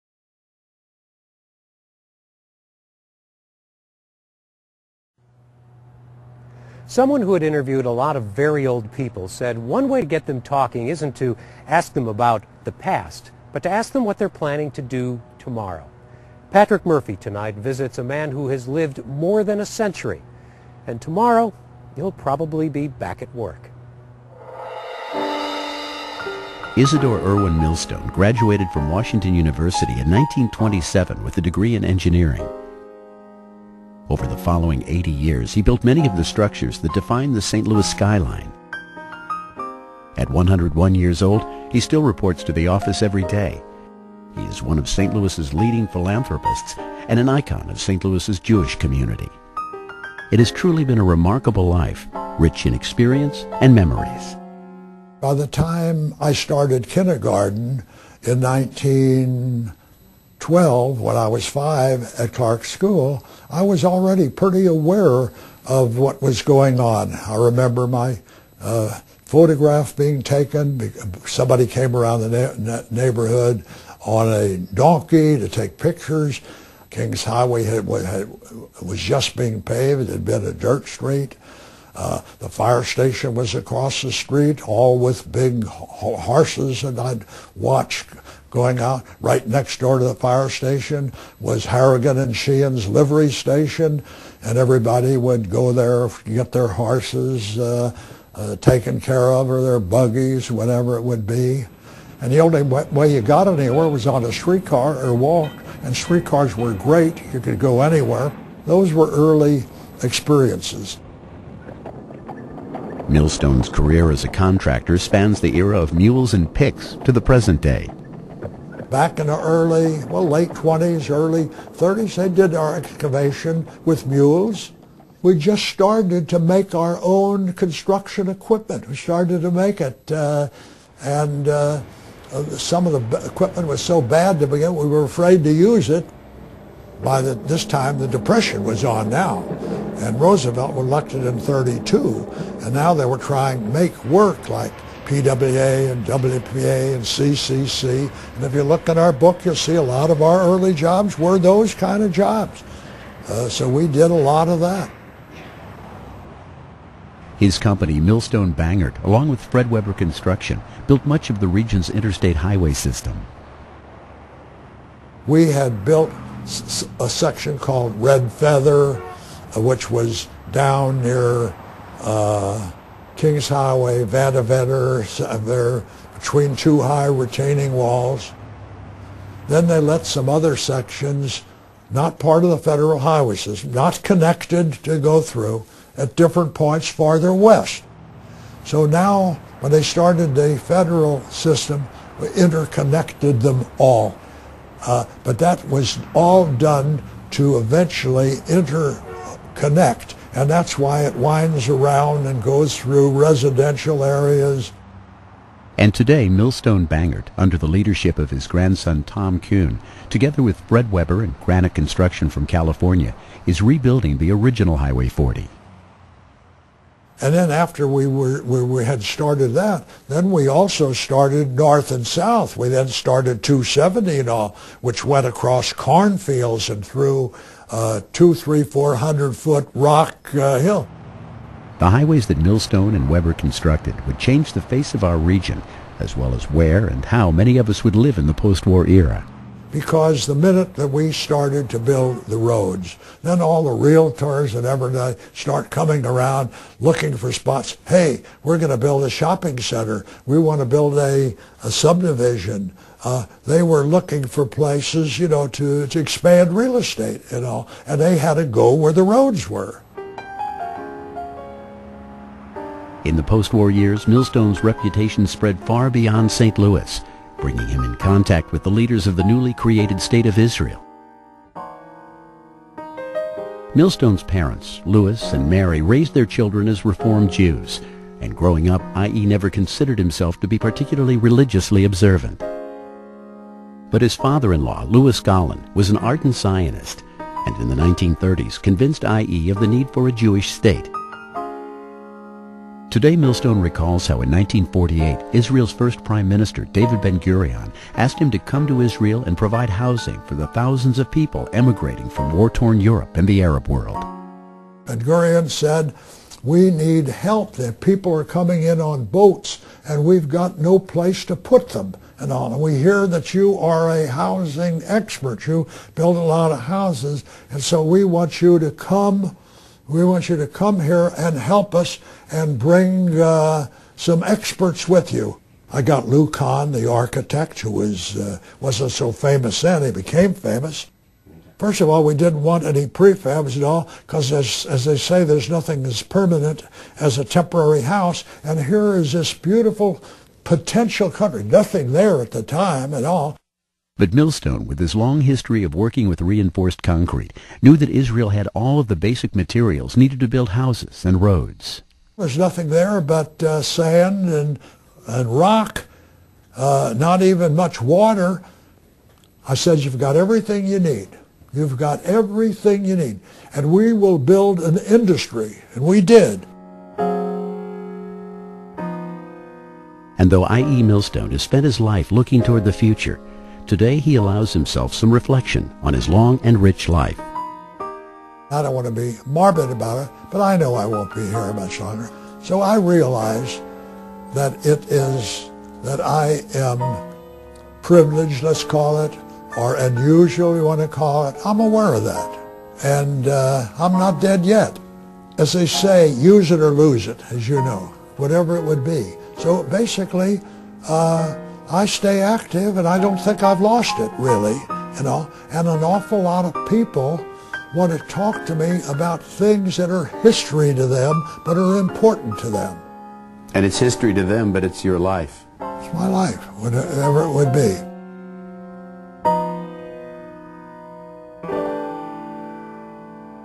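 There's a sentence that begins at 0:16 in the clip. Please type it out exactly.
Patrick Murphy tonight visits a man who has lived more than a century, and tomorrow he'll probably be back at work.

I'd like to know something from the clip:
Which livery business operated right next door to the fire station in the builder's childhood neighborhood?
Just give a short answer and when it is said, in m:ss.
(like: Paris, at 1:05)
Harrigan and Sheehan's, at 1:31.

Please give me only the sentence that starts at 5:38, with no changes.
And here is this beautiful potential country, nothing there at the time at all.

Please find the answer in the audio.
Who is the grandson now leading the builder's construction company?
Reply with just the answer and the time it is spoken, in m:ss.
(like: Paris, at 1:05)
Tom Kuhn, at 3:29.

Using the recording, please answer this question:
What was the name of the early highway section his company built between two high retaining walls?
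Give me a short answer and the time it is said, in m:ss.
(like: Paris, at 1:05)
Red Feather, at 2:48.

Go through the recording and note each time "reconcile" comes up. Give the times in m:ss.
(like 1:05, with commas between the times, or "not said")
not said.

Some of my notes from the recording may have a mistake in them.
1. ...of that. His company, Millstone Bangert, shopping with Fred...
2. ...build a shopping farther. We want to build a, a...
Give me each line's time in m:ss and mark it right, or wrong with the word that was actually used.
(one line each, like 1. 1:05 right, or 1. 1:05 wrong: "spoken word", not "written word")
1. 2:34 wrong: "along", not "shopping"
2. 4:08 wrong: "center", not "farther".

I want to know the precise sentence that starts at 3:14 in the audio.
Uh, but that was all done to eventually interconnect and that's why it winds around and goes through residential areas.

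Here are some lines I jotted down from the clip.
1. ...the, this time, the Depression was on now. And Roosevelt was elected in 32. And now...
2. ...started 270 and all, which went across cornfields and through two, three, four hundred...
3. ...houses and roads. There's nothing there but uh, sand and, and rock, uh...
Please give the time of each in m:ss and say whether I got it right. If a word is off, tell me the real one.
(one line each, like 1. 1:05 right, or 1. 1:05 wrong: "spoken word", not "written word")
1. 2:17 right
2. 3:42 right
3. 5:50 right.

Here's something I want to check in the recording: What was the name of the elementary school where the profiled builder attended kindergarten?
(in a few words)
Clark School.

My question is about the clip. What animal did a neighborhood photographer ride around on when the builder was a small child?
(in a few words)
Donkey.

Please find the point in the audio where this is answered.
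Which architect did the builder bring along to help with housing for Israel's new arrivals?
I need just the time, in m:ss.
5:26.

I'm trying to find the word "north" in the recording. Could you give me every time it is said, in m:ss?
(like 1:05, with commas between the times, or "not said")
3:41.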